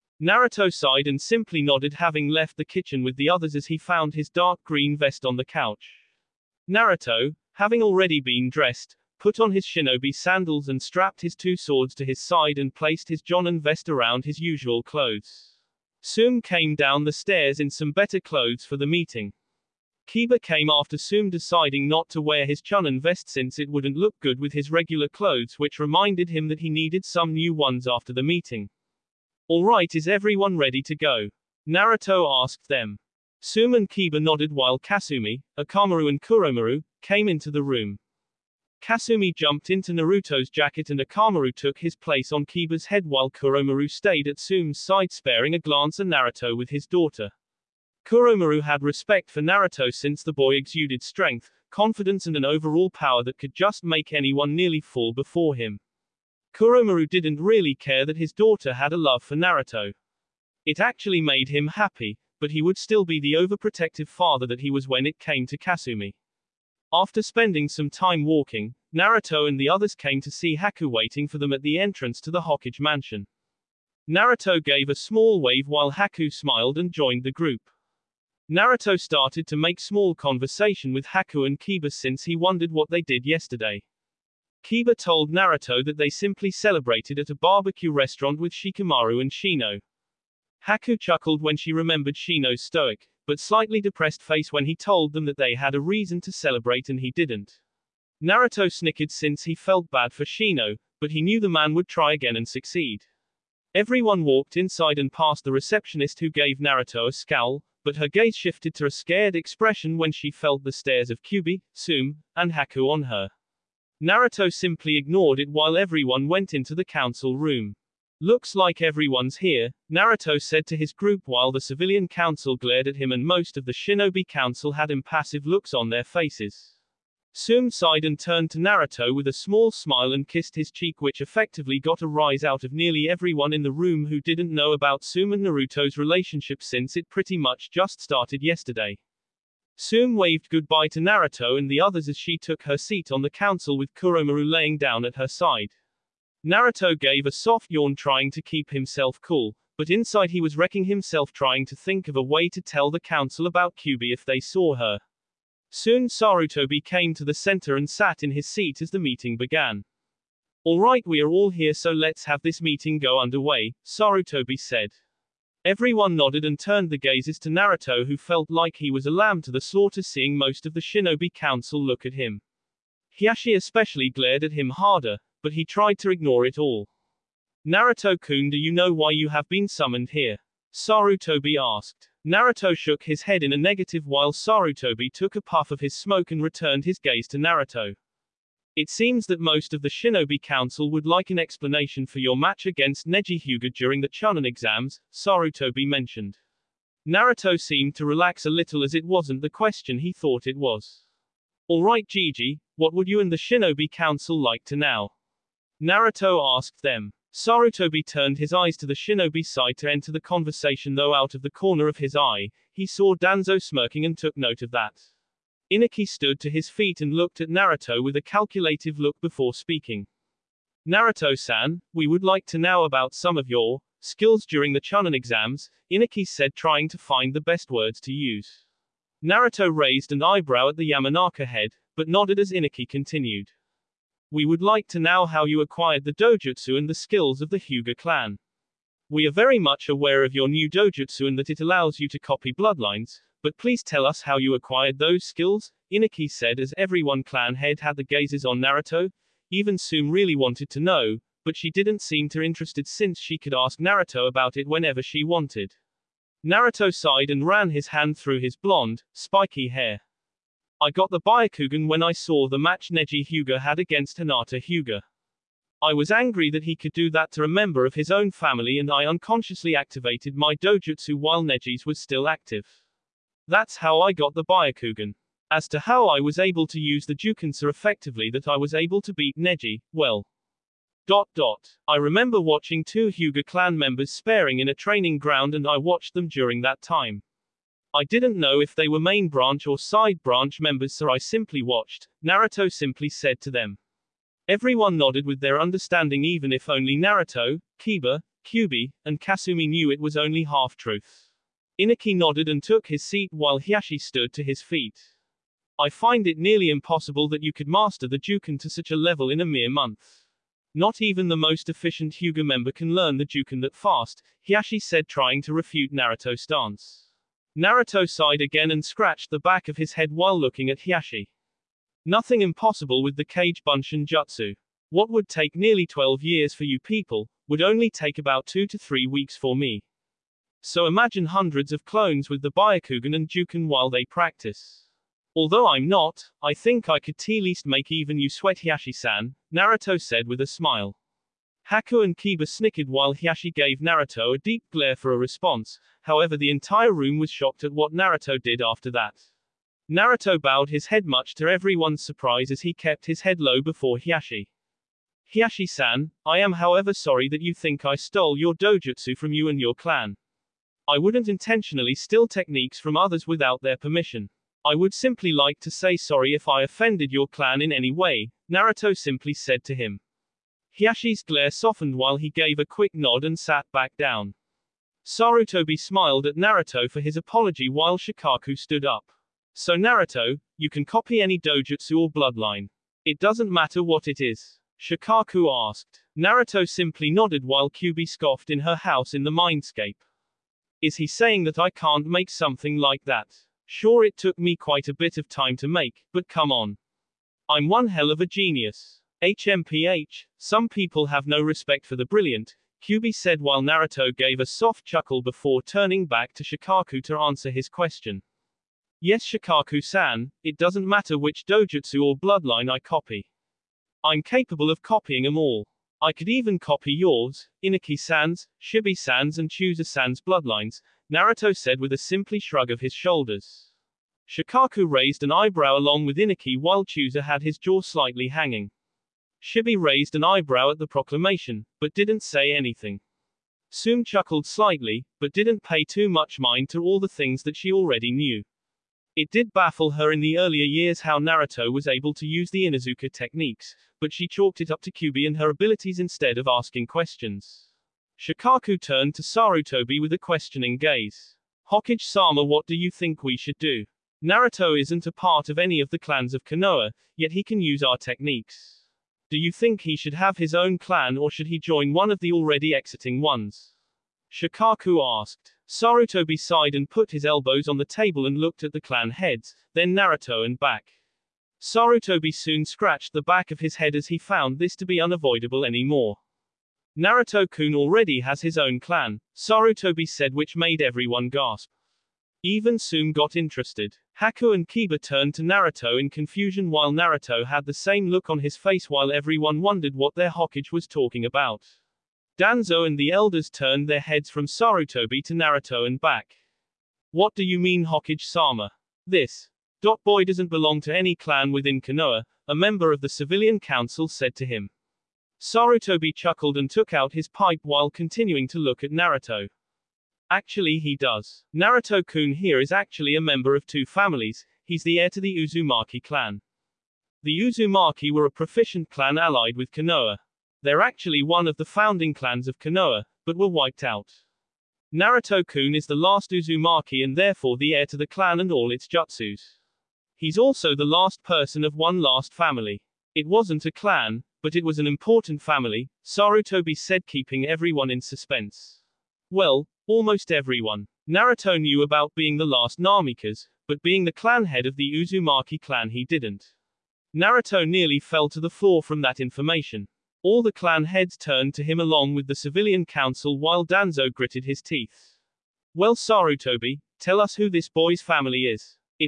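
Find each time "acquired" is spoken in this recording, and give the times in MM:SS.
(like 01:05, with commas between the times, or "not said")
03:55, 04:04.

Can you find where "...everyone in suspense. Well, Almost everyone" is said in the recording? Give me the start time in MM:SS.
08:57.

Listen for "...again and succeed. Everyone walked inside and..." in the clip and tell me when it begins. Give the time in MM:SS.
01:42.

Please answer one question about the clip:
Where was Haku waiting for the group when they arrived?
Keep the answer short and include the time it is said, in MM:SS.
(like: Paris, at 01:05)
entrance to the Hokage mansion, at 01:12.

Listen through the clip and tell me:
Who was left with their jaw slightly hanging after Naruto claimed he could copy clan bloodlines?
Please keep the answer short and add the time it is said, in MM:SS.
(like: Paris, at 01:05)
Chusa, at 07:06.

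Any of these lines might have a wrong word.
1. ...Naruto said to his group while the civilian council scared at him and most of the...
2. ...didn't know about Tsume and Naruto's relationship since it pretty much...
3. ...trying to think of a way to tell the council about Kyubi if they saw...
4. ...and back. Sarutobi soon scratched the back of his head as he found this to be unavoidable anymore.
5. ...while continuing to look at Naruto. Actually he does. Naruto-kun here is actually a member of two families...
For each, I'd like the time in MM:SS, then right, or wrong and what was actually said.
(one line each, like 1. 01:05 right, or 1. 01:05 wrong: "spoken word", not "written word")
1. 01:59 wrong: "glared", not "scared"
2. 02:14 right
3. 02:31 right
4. 07:50 right
5. 08:27 right.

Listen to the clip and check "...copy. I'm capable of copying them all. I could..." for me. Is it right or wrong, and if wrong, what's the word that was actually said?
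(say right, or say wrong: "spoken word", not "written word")
right.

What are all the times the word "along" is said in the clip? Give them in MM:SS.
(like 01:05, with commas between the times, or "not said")
07:05, 09:11.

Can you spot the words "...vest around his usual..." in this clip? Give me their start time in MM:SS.
00:13.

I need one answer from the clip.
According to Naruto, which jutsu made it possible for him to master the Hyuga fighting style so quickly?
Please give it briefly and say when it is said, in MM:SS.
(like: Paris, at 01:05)
Kage Bunshin Jutsu, at 05:23.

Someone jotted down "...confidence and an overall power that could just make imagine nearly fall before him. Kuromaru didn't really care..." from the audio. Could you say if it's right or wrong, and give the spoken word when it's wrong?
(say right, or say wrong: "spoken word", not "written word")
wrong: "anyone", not "imagine".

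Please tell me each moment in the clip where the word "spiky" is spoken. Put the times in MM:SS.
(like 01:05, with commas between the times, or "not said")
04:19.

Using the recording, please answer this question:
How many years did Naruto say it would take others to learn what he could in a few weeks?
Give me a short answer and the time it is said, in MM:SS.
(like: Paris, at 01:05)
12, at 05:25.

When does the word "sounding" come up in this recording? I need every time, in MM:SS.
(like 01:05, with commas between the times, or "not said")
not said.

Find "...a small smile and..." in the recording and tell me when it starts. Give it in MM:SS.
02:09.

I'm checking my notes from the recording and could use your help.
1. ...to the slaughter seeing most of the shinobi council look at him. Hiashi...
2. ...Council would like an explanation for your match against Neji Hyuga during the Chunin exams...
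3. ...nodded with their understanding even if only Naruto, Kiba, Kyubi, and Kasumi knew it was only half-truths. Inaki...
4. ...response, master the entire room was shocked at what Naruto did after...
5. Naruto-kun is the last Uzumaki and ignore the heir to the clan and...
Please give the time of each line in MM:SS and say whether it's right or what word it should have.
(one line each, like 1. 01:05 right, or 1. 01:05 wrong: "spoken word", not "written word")
1. 02:49 right
2. 03:10 right
3. 04:54 right
4. 05:45 wrong: "however", not "master"
5. 08:44 wrong: "therefore", not "ignore".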